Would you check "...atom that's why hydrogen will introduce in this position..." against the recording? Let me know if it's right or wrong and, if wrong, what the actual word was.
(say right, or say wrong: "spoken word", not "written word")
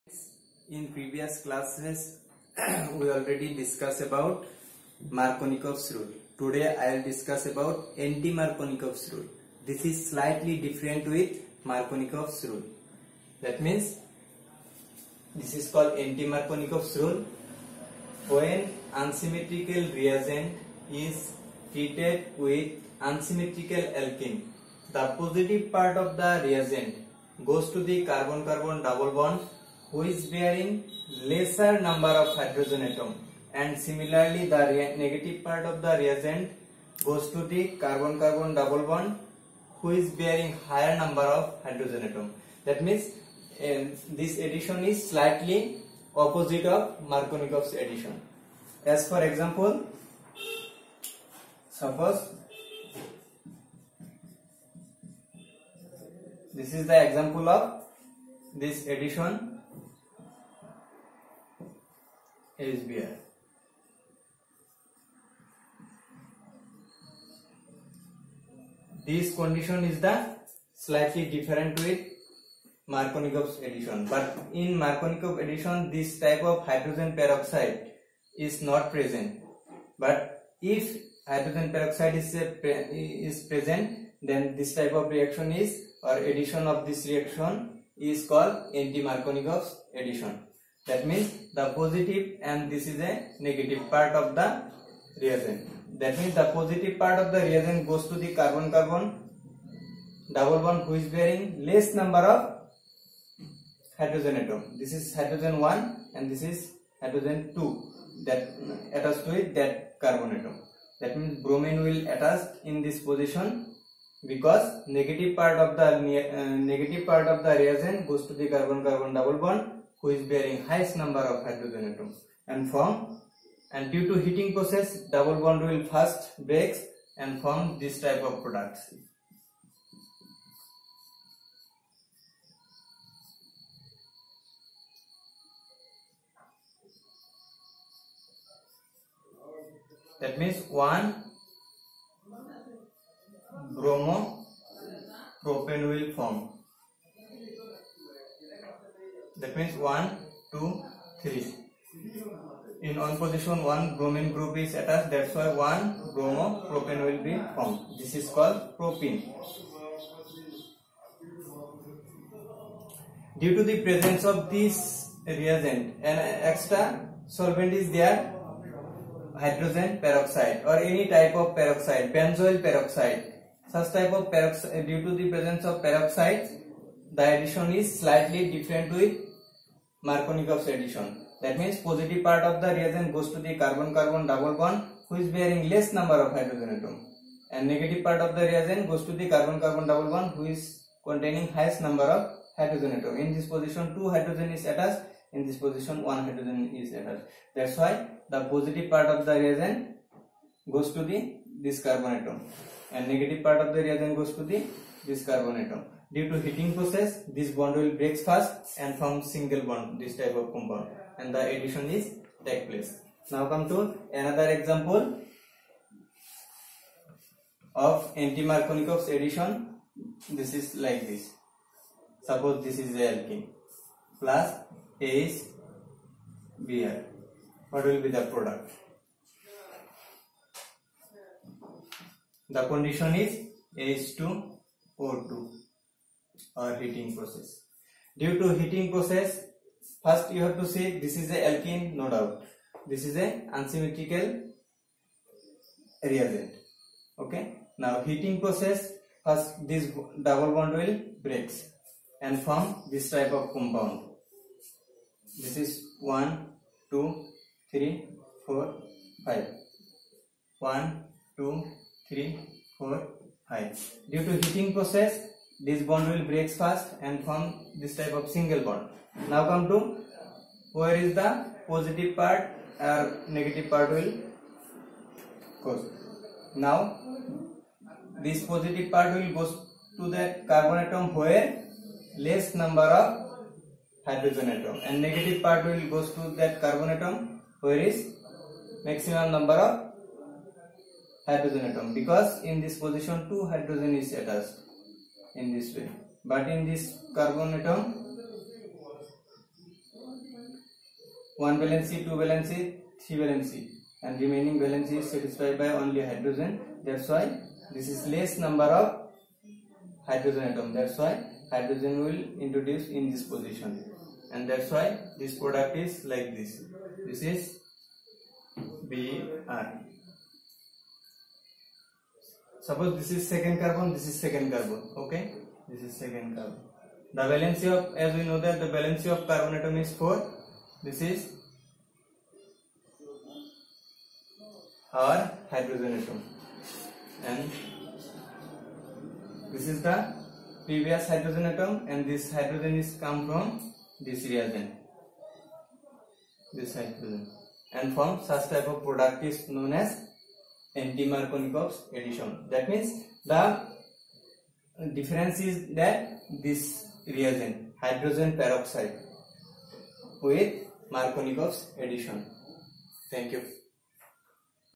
right.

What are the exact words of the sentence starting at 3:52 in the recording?
The condition is H2 4 to our heating process.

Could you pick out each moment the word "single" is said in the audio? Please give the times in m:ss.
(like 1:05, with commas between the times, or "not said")
3:29, 4:28.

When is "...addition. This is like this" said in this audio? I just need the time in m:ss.
3:39.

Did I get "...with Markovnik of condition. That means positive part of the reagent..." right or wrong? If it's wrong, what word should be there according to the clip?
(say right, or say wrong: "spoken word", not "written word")
wrong: "addition", not "condition".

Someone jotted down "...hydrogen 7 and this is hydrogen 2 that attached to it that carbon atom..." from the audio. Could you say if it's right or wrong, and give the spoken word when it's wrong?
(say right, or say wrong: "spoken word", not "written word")
wrong: "1", not "7".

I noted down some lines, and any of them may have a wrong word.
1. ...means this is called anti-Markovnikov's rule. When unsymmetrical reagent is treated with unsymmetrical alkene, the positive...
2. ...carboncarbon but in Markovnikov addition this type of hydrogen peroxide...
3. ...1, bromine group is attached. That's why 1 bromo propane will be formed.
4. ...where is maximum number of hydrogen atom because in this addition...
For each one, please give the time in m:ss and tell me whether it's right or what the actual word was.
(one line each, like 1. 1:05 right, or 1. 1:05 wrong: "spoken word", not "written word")
1. 0:13 right
2. 1:13 wrong: "addition", not "carboncarbon"
3. 2:33 right
4. 4:47 wrong: "position", not "addition".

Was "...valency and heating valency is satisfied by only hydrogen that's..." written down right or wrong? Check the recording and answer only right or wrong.
wrong.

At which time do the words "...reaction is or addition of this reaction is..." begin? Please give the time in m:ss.
1:25.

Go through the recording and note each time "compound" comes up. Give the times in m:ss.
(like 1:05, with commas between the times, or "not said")
3:30, 4:13.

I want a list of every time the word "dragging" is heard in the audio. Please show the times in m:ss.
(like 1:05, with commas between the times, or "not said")
not said.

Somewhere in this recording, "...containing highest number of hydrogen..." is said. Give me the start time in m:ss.
3:11.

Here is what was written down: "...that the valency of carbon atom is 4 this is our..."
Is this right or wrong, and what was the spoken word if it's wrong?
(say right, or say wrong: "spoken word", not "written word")
right.